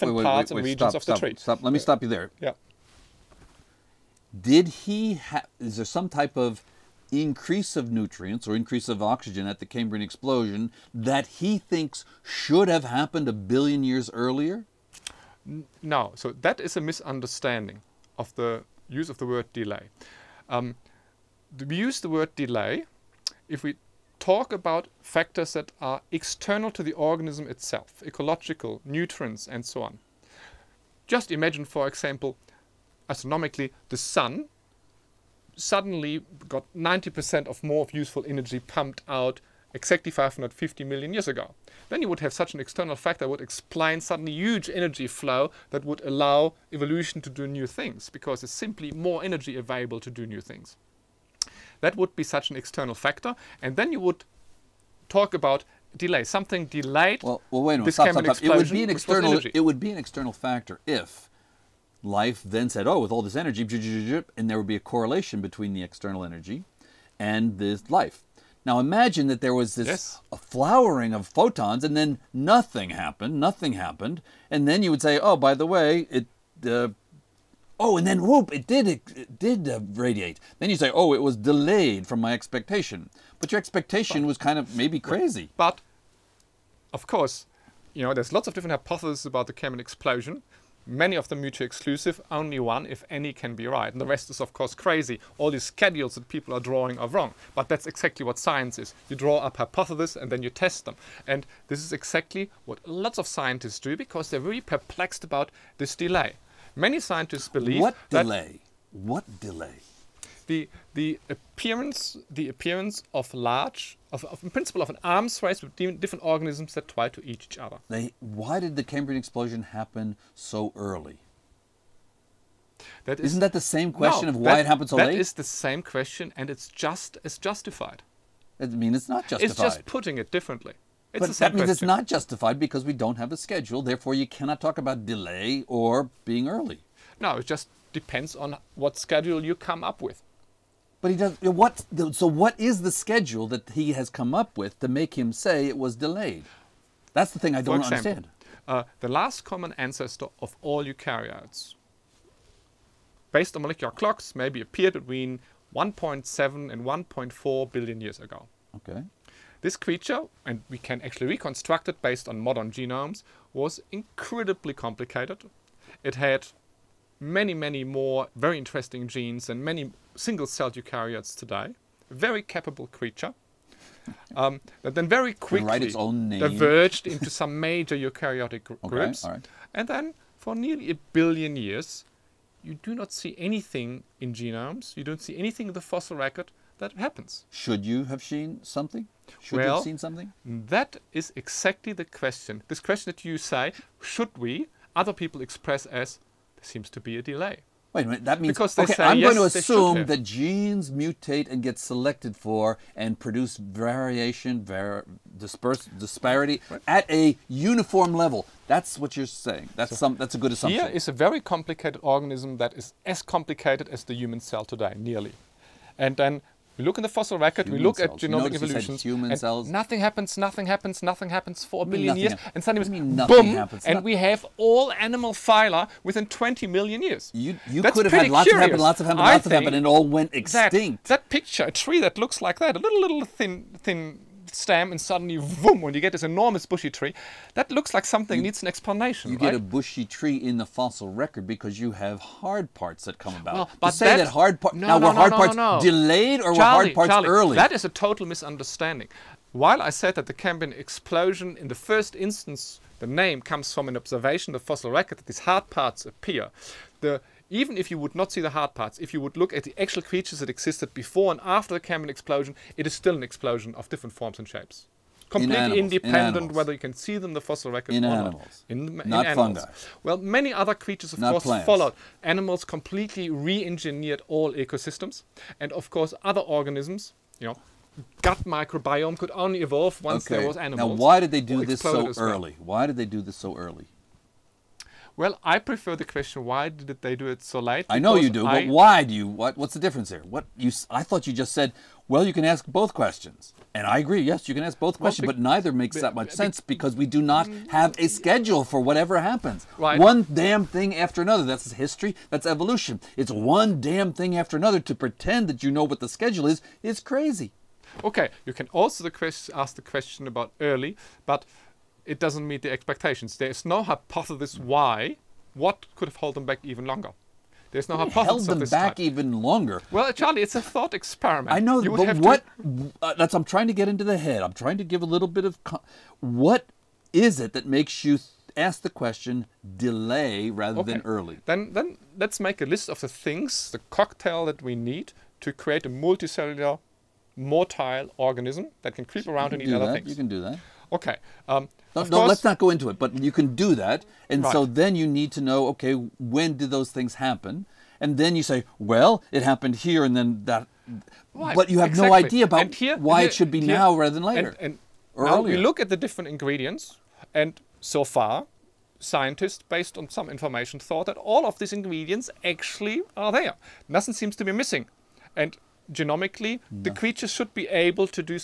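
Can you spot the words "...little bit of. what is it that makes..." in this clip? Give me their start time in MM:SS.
05:25.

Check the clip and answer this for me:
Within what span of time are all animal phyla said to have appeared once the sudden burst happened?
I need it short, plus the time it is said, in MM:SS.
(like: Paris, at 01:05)
20 million years, at 03:46.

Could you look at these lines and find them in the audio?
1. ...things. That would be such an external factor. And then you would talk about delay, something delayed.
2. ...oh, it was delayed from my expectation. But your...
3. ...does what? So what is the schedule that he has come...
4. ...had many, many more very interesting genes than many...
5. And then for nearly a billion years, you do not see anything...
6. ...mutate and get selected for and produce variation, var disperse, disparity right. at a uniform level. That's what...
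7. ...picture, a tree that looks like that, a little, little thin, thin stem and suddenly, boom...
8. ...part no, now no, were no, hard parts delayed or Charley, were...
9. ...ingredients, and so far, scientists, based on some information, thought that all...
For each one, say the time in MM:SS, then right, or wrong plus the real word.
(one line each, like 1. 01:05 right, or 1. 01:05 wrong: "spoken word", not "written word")
1. 00:50 right
2. 01:20 right
3. 02:21 right
4. 02:46 right
5. 02:59 right
6. 03:20 right
7. 03:51 right
8. 04:04 right
9. 05:56 right.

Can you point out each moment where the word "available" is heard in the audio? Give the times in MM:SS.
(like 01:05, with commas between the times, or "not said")
00:49.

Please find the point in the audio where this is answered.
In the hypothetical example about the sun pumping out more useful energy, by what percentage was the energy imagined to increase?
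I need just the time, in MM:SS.
00:36.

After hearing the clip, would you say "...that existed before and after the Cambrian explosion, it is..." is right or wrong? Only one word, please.
right.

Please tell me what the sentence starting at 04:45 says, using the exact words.
Well, I prefer the question: Why did they do it so late?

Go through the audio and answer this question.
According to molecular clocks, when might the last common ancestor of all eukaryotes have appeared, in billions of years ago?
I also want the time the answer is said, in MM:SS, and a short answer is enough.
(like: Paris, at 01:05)
1.7 to 1.4 billion years ago, at 02:34.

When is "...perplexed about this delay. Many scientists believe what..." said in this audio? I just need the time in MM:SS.
01:44.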